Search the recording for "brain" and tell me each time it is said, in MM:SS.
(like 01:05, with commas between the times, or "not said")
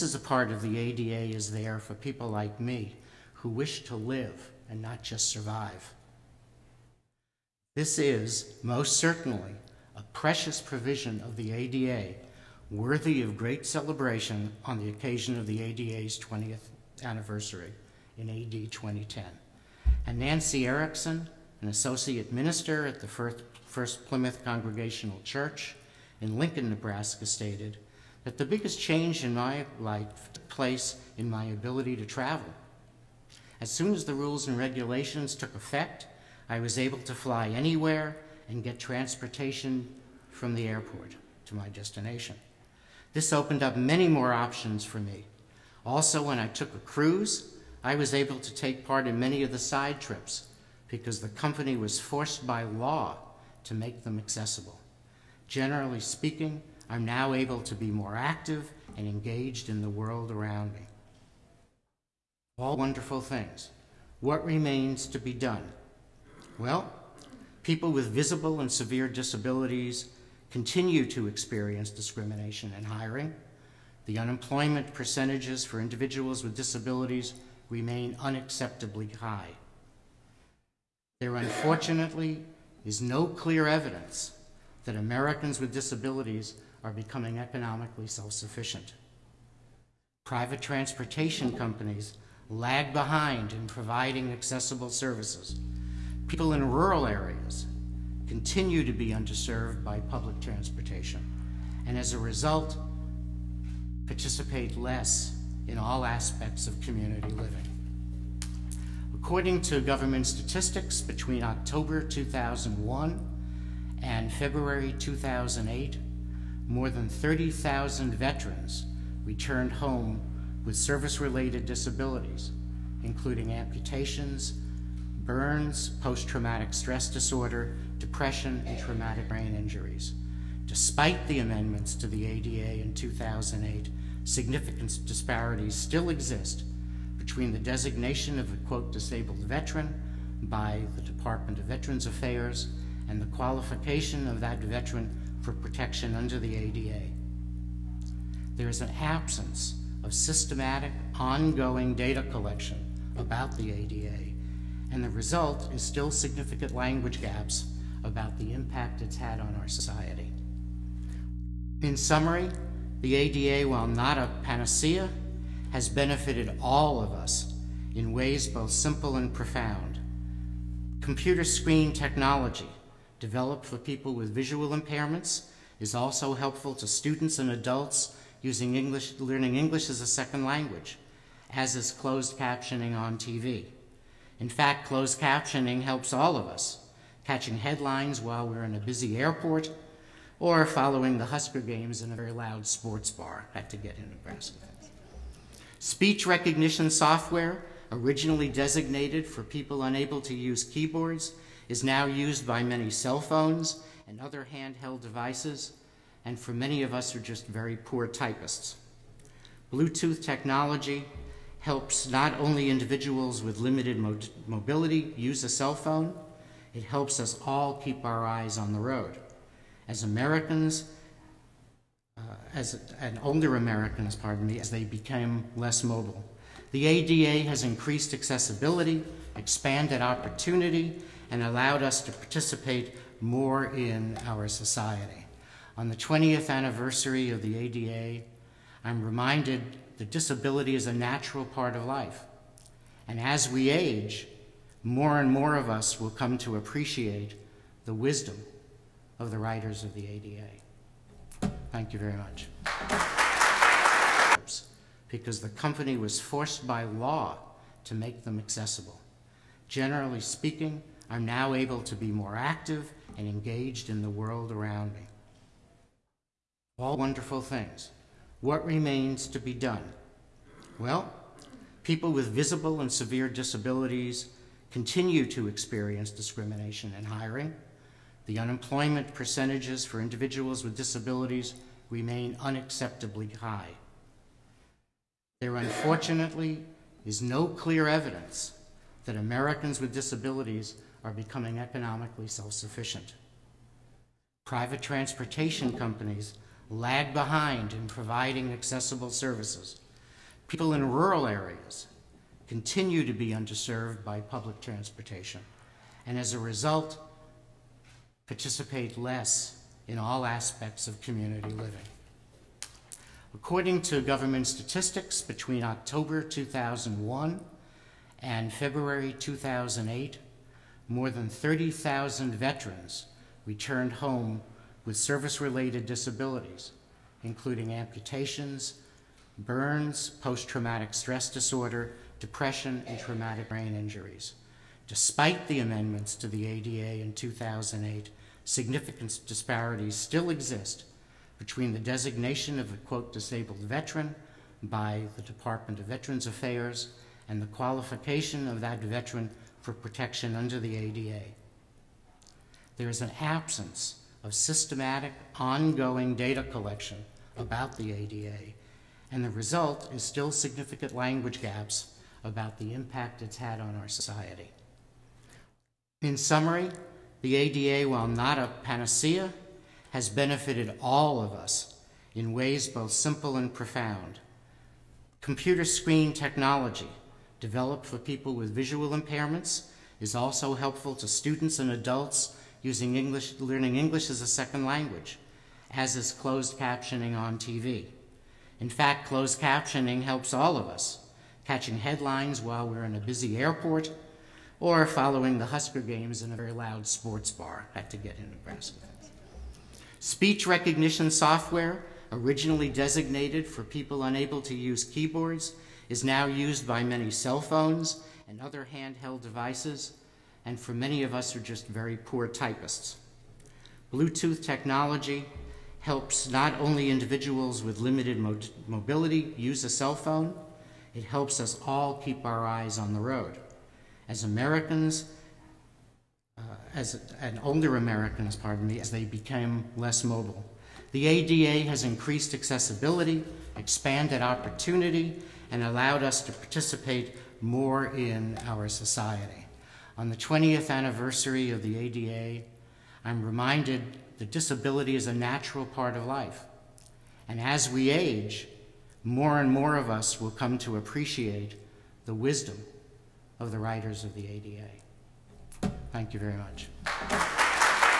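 02:09, 05:33.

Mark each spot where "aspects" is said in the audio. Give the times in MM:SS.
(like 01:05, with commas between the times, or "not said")
01:46, 05:10.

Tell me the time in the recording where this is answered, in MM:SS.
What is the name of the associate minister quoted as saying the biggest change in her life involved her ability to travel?
00:20.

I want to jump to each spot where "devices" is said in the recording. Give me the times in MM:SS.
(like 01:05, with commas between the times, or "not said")
03:25, 06:49.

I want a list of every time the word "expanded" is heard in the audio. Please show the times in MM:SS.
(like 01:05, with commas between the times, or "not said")
03:49, 07:13.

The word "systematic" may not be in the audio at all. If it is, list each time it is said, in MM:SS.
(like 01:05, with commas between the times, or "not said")
02:30, 05:54.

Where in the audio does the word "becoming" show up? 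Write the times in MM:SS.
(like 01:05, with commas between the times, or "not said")
01:26, 04:51.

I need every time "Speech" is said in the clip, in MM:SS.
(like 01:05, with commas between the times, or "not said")
03:15, 06:39.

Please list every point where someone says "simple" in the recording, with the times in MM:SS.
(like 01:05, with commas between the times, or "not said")
02:48, 06:12.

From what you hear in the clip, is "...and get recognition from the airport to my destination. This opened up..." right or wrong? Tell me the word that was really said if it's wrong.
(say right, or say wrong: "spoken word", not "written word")
wrong: "transportation", not "recognition".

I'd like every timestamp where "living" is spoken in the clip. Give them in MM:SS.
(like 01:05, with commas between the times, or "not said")
01:47, 05:11.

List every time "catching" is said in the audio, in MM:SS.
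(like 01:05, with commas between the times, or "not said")
03:07, 06:31.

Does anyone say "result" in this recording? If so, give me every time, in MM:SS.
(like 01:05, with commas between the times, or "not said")
01:42, 02:35, 05:06, 05:59.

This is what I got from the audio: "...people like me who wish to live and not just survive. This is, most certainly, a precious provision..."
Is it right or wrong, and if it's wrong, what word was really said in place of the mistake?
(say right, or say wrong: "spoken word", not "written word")
right.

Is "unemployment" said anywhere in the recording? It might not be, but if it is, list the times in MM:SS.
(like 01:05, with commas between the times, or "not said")
01:14, 04:38.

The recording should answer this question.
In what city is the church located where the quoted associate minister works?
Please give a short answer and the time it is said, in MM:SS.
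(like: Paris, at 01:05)
Lincoln, at 00:26.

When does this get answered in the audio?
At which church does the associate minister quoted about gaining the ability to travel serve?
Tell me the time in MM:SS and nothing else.
00:23.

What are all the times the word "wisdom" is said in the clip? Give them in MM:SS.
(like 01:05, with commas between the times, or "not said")
04:07, 07:32.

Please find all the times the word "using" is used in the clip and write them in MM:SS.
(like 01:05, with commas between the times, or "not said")
02:58, 06:22.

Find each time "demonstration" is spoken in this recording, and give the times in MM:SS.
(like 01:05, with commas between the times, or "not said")
not said.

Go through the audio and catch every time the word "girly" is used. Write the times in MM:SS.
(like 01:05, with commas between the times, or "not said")
not said.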